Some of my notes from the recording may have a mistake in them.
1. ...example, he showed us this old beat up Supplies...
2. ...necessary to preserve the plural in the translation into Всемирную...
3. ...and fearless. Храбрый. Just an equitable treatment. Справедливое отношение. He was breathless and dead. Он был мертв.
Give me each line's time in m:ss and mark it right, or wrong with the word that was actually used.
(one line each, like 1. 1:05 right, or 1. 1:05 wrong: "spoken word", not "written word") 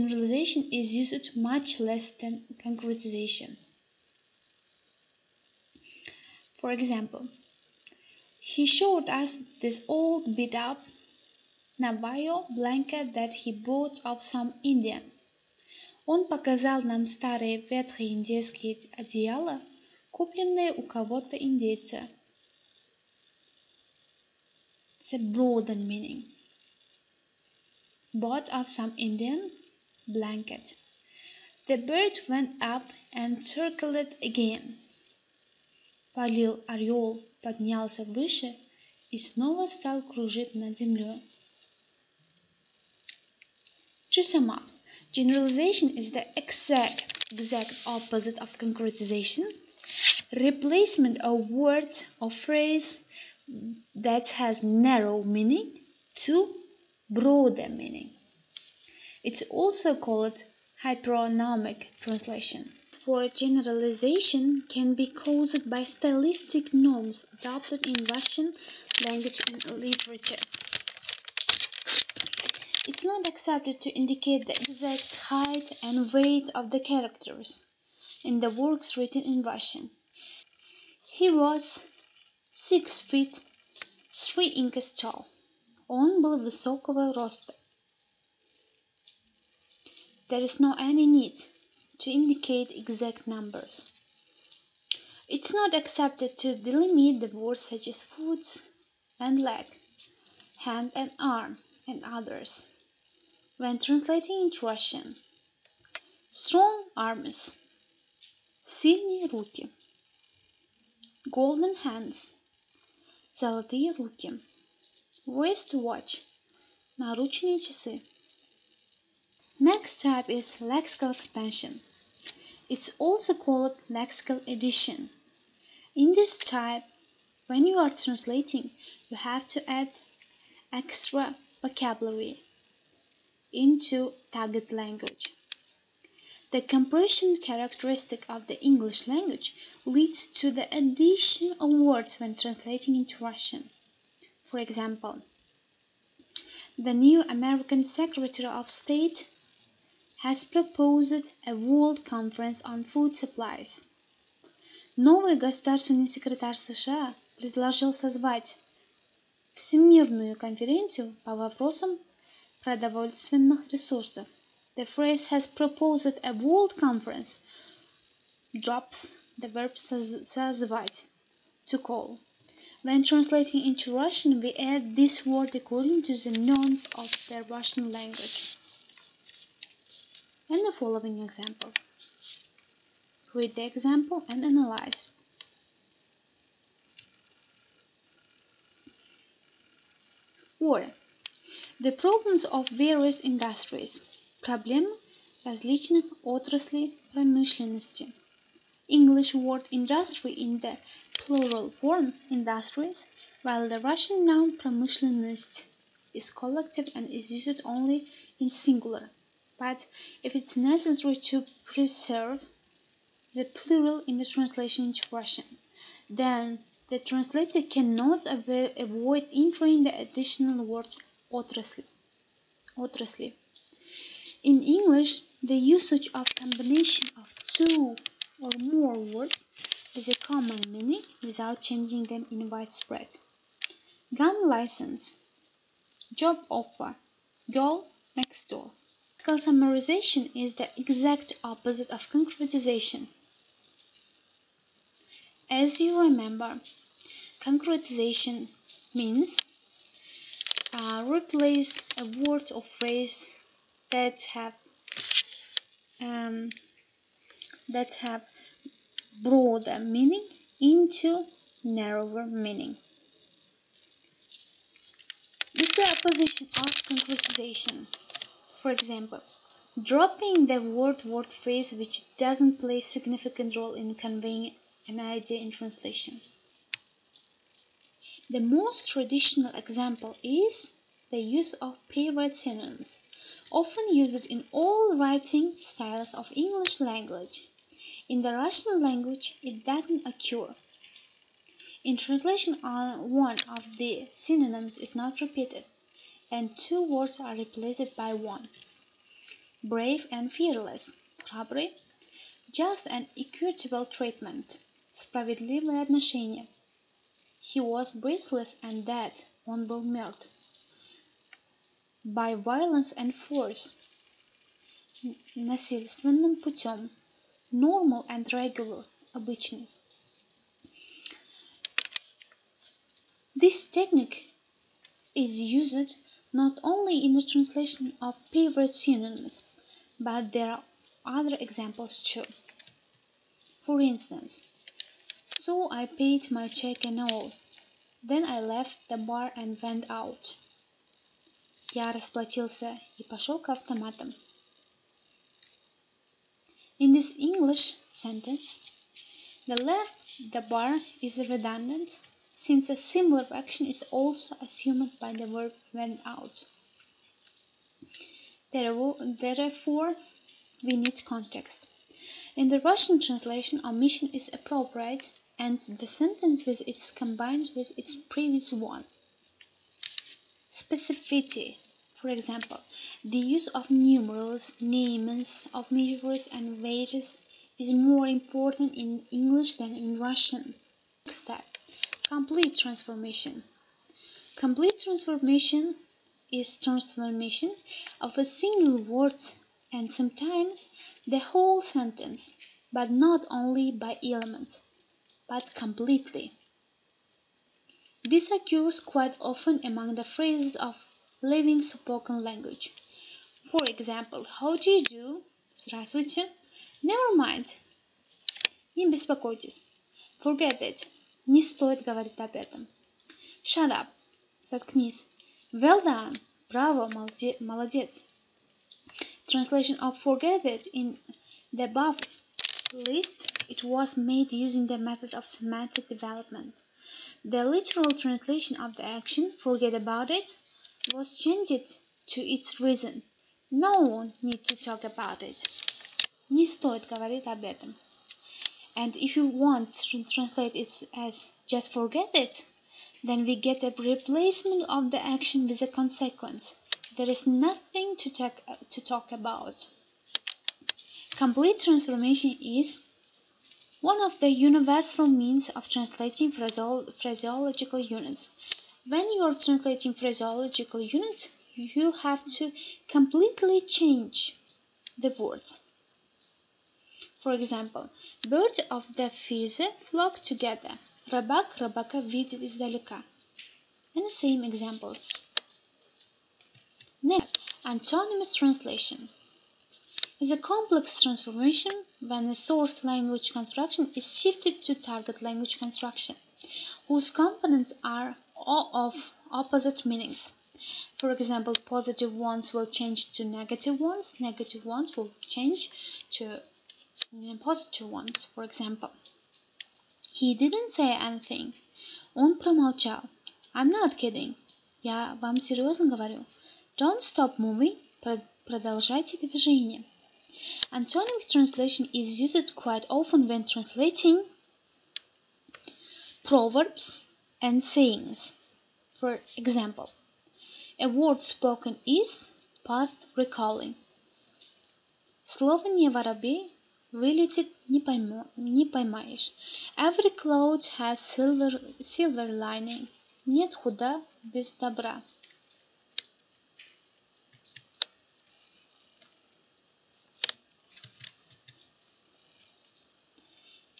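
1. 0:06 wrong: "Navajo", not "Supplies"
2. 3:30 wrong: "Russian", not "Всемирную"
3. 5:00 right.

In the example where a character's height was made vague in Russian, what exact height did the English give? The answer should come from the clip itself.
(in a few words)
6 feet 3 inches.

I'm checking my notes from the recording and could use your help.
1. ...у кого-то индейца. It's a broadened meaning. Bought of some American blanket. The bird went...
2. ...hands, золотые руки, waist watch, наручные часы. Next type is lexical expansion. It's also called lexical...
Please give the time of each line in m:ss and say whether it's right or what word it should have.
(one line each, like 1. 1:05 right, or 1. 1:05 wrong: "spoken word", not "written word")
1. 0:20 wrong: "Indian", not "American"
2. 1:51 right.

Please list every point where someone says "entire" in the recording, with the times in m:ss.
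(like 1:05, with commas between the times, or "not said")
not said.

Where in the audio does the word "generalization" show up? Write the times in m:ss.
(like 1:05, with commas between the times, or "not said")
0:45, 1:03.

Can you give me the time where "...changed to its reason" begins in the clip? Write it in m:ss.
7:11.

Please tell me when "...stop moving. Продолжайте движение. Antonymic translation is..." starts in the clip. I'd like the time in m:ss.
8:27.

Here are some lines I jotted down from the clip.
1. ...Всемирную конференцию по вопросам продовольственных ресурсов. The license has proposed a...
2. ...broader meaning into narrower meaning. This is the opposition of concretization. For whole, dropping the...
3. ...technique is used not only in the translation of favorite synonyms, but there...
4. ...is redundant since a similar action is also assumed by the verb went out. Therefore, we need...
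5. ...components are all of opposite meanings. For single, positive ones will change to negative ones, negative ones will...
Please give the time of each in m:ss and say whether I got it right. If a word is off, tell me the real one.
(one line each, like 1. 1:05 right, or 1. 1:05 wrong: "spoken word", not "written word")
1. 2:39 wrong: "phrase", not "license"
2. 4:19 wrong: "example", not "whole"
3. 5:23 right
4. 5:51 right
5. 8:07 wrong: "example", not "single".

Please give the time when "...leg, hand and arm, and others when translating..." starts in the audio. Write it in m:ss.
1:39.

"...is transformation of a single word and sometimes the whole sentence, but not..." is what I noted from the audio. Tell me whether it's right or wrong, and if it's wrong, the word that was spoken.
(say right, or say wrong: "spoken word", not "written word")
right.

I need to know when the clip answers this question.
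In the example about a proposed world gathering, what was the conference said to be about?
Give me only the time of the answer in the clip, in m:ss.
2:32.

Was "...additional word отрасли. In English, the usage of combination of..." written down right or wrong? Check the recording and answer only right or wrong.
right.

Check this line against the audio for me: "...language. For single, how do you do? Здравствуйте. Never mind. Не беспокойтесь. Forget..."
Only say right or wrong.
wrong.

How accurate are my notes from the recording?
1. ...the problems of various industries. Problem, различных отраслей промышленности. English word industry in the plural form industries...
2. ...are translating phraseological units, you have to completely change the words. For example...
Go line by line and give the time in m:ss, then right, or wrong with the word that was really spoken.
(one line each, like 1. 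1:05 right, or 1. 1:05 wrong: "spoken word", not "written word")
1. 3:11 right
2. 7:39 right.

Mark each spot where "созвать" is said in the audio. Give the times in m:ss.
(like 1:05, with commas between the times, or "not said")
2:37, 2:49.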